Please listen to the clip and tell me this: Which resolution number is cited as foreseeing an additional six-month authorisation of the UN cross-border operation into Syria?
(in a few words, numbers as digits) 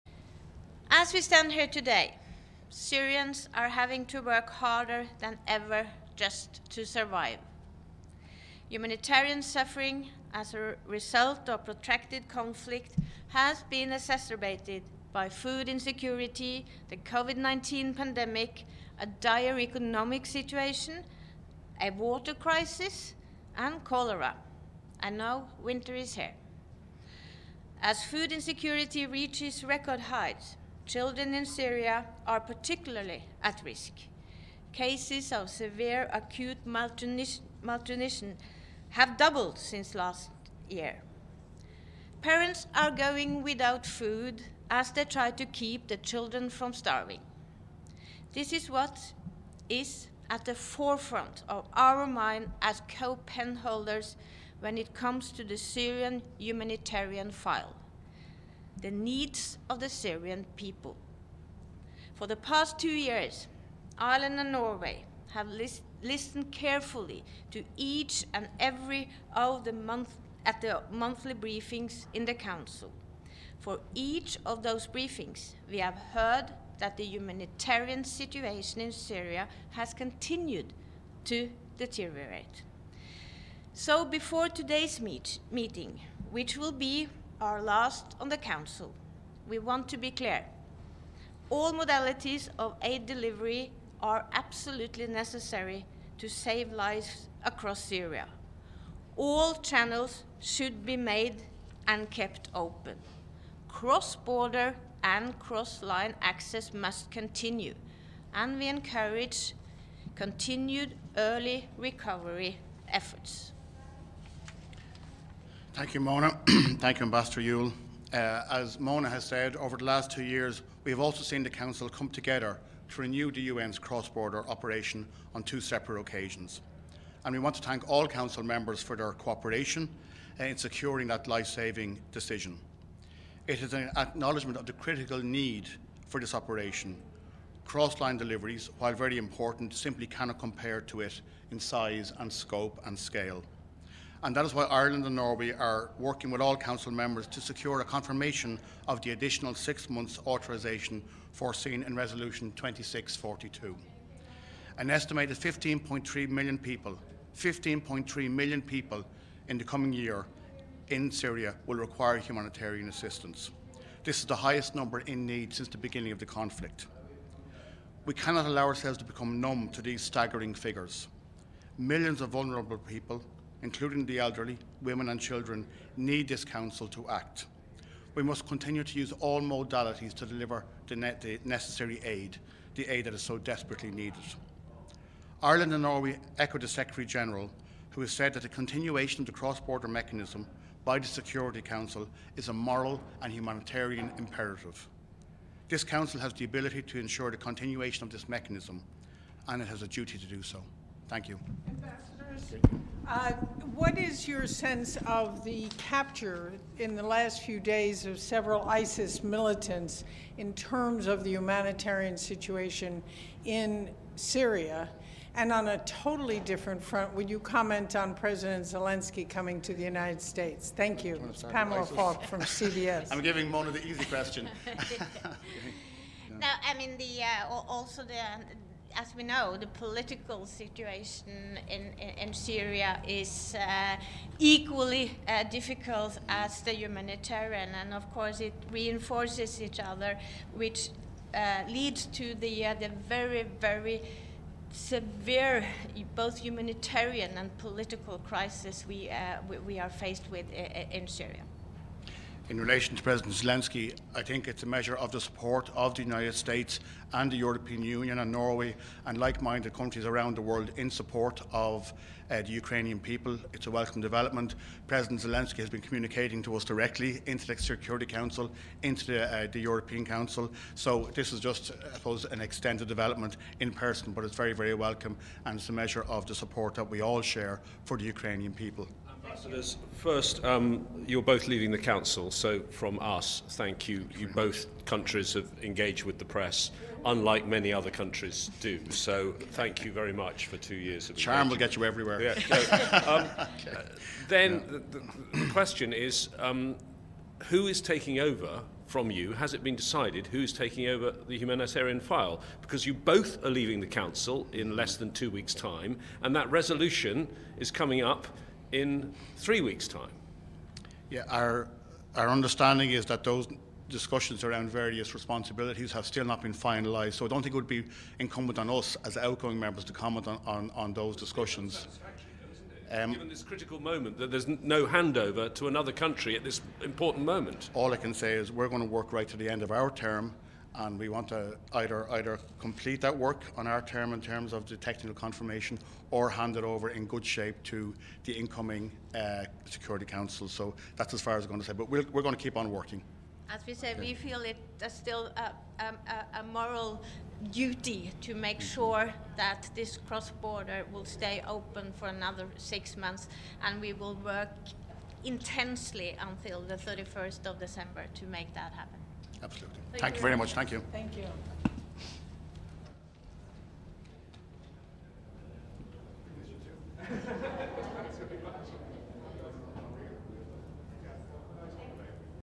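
2642.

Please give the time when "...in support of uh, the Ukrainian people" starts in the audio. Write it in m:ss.
4:20.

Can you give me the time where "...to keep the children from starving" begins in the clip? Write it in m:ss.
0:45.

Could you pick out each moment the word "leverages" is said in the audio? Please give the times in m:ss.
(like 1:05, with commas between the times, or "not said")
not said.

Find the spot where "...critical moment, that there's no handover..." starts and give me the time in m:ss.
5:23.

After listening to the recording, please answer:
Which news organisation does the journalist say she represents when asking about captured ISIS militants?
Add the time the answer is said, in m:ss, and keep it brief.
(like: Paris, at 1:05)
CBS, at 3:42.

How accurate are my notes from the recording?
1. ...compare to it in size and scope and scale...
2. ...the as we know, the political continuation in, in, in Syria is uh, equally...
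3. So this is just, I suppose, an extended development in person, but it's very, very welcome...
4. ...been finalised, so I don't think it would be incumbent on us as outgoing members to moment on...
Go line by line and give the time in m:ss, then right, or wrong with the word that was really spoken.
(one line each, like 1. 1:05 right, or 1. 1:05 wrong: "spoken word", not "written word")
1. 2:20 right
2. 3:48 wrong: "situation", not "continuation"
3. 4:30 right
4. 5:16 wrong: "comment", not "moment".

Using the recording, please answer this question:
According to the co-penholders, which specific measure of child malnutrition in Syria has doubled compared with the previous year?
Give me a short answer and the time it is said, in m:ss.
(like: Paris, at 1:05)
severe acute malnutrition, at 0:35.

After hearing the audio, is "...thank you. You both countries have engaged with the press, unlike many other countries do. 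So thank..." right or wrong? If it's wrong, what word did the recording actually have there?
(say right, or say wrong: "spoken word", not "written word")
right.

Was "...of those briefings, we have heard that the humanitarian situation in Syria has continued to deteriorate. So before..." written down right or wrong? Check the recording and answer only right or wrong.
right.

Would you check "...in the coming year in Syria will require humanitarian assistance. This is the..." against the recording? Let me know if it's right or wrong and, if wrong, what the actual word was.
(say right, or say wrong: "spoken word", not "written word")
right.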